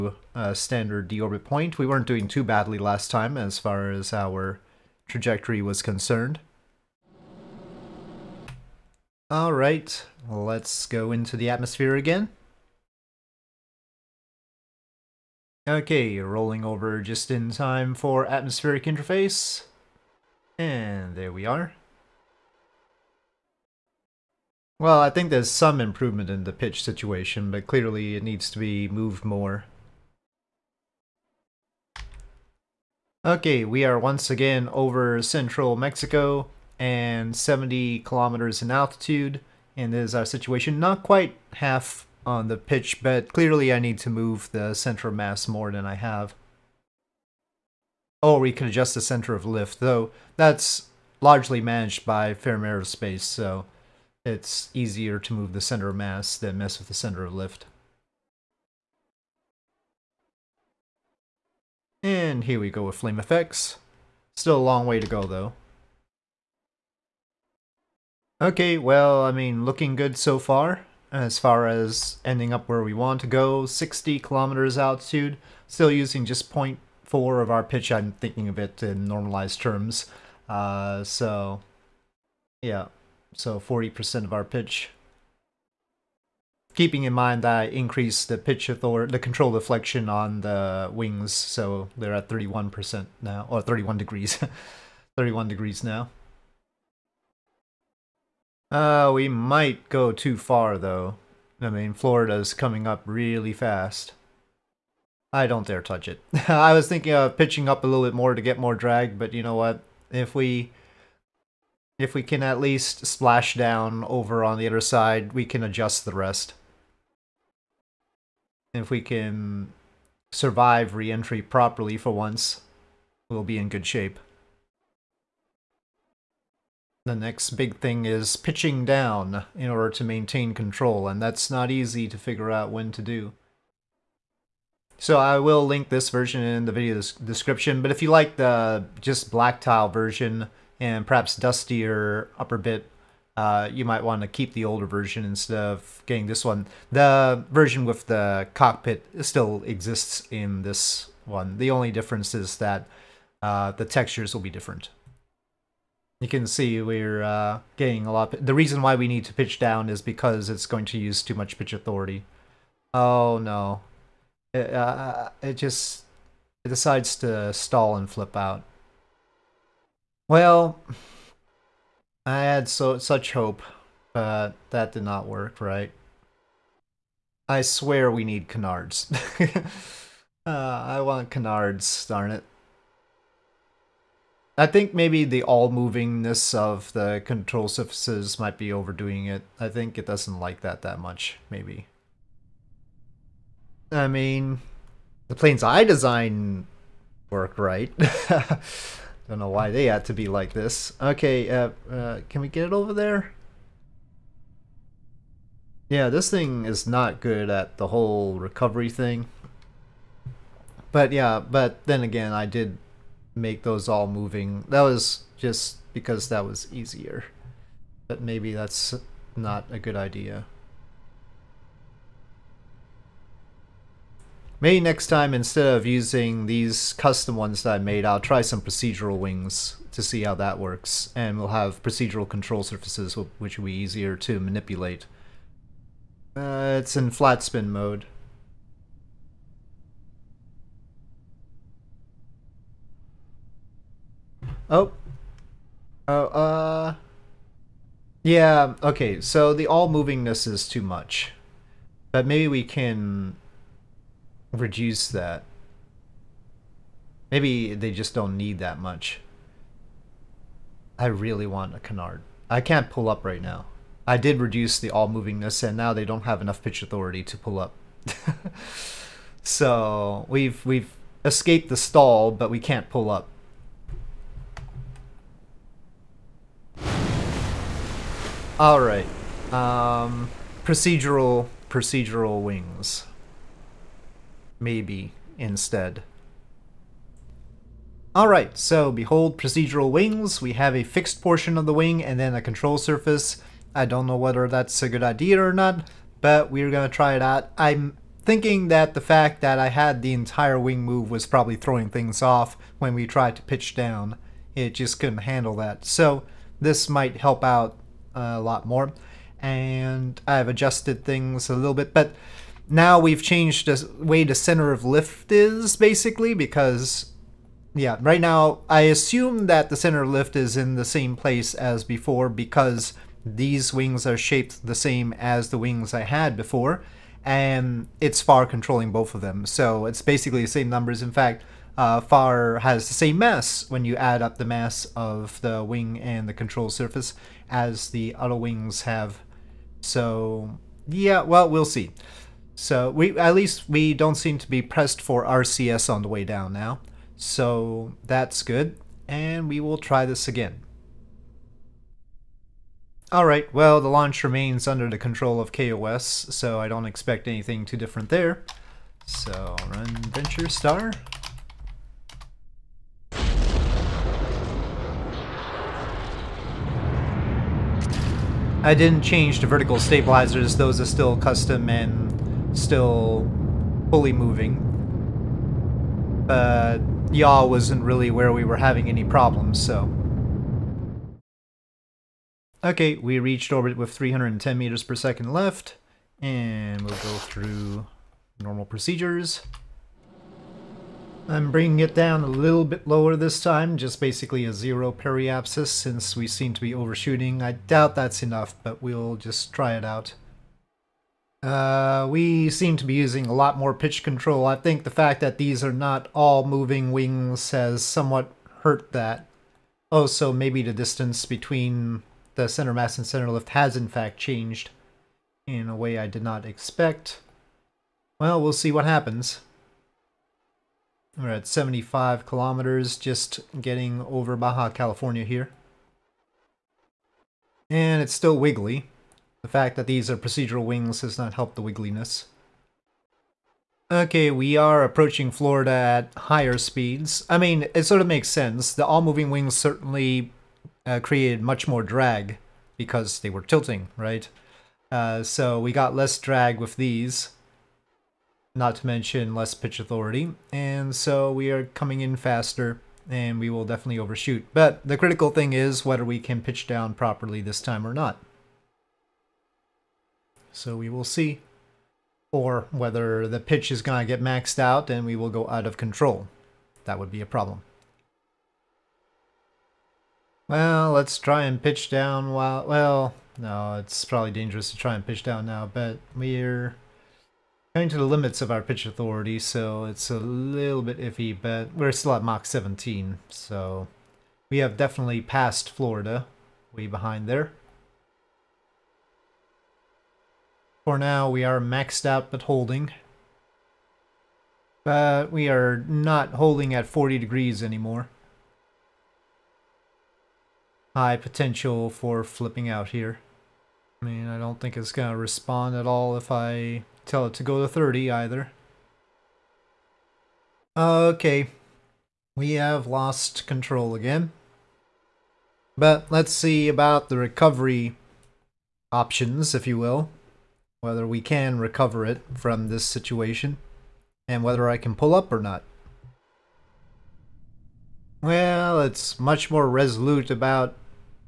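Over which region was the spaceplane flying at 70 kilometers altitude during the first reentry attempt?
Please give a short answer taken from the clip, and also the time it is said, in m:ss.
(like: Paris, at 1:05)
Central Mexico, at 0:35.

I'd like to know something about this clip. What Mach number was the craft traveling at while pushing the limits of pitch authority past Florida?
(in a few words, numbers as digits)
Mach 17.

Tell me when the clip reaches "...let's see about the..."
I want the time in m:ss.
8:36.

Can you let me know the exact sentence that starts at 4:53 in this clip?
I don't know whether that's a good idea or not, but we're gonna try it out.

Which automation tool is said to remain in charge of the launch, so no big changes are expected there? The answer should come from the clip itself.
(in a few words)
KOS.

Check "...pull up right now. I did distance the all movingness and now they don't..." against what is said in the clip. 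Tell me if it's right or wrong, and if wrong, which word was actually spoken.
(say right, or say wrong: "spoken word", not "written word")
wrong: "reduce", not "distance".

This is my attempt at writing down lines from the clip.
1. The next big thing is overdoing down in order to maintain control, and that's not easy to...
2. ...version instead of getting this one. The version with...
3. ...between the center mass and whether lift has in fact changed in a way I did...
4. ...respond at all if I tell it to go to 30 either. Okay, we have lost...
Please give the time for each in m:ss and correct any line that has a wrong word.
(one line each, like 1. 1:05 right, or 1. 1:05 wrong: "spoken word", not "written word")
1. 2:07 wrong: "pitching", not "overdoing"
2. 2:24 right
3. 6:51 wrong: "center", not "whether"
4. 8:25 right.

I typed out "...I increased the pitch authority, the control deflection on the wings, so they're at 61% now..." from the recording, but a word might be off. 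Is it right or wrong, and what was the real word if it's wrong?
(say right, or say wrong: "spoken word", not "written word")
wrong: "31", not "61".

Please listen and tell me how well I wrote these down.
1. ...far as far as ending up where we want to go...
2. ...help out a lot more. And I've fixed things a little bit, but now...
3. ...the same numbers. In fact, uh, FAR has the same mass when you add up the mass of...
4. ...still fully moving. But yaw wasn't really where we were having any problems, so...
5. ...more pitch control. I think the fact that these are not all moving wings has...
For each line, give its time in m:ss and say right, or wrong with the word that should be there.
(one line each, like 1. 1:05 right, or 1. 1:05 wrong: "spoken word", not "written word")
1. 1:10 right
2. 5:07 wrong: "adjusted", not "fixed"
3. 5:30 right
4. 6:12 right
5. 6:43 right.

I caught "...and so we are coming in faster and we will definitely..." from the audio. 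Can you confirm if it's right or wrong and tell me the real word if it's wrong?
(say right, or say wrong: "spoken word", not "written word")
right.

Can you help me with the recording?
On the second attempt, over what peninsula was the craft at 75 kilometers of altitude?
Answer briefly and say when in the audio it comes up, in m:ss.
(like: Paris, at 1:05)
Baja California, at 7:04.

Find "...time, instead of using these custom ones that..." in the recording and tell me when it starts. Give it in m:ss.
3:45.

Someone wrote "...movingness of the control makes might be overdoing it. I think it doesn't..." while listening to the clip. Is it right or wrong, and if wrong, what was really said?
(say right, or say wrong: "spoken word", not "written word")
wrong: "surfaces", not "makes".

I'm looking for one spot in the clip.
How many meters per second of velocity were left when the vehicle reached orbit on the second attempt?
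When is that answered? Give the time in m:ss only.
6:23.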